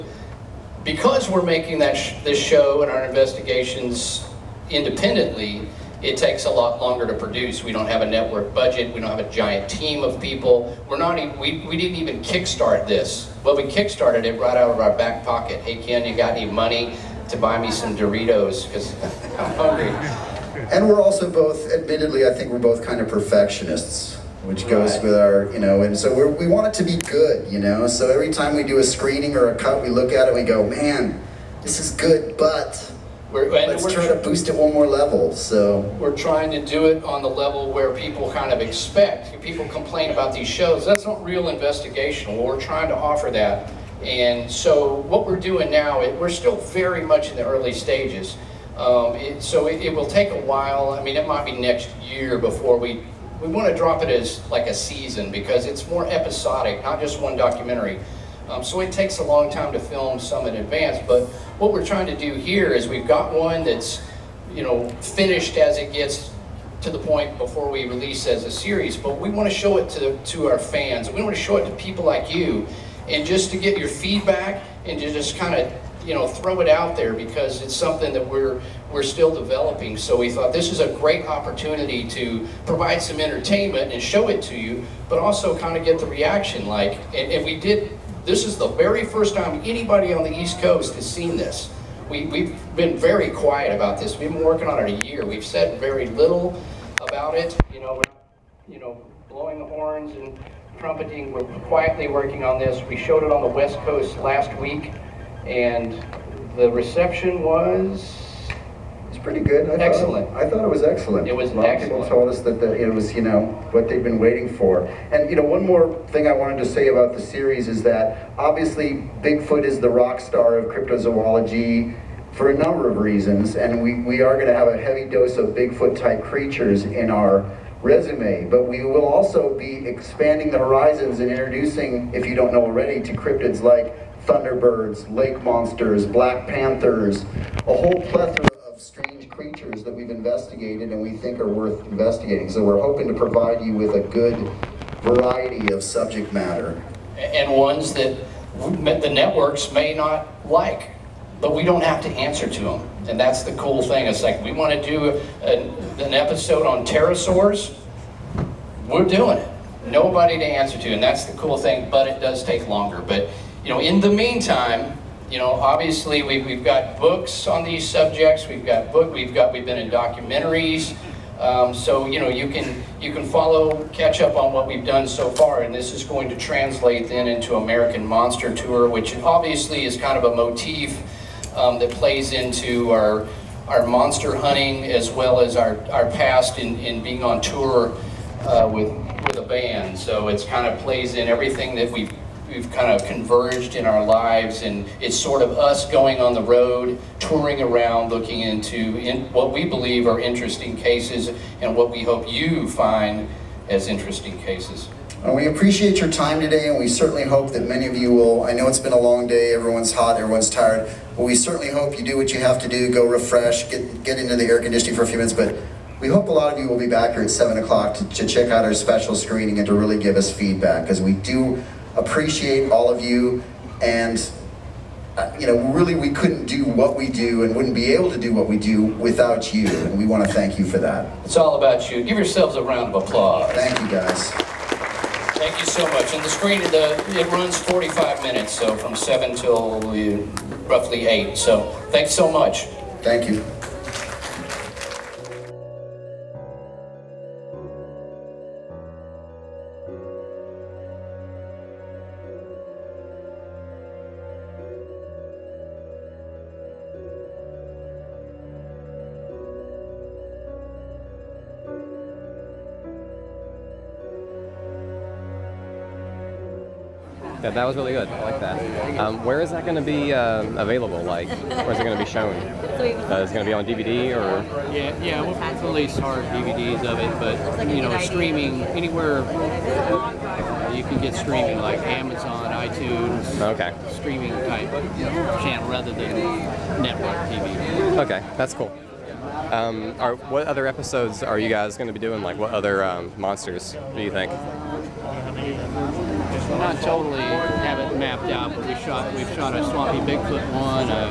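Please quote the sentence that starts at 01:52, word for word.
Of people told us that the, it was, you know, what they've been waiting for.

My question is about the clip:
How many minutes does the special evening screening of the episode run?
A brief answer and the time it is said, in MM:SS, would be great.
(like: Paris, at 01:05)
45, at 03:57.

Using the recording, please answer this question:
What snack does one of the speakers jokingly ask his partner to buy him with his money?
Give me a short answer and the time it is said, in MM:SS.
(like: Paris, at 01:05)
Doritos, at 00:17.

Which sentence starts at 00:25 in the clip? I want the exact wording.
with our, you know, and so we want it to be good, you know.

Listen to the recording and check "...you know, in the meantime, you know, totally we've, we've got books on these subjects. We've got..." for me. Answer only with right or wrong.
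wrong.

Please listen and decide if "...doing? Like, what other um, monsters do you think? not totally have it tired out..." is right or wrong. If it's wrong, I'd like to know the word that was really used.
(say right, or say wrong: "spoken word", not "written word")
wrong: "mapped", not "tired".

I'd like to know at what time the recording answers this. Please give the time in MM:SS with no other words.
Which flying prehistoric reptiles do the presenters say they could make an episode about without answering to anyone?
02:36.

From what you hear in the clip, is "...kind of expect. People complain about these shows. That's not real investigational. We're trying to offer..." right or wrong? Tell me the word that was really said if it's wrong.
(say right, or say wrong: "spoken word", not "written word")
right.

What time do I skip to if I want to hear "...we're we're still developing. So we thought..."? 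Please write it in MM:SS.
01:18.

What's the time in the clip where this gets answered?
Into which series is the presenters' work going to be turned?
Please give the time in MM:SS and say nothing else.
02:57.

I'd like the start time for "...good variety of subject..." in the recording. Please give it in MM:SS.
02:24.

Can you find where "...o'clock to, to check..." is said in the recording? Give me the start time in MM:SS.
03:37.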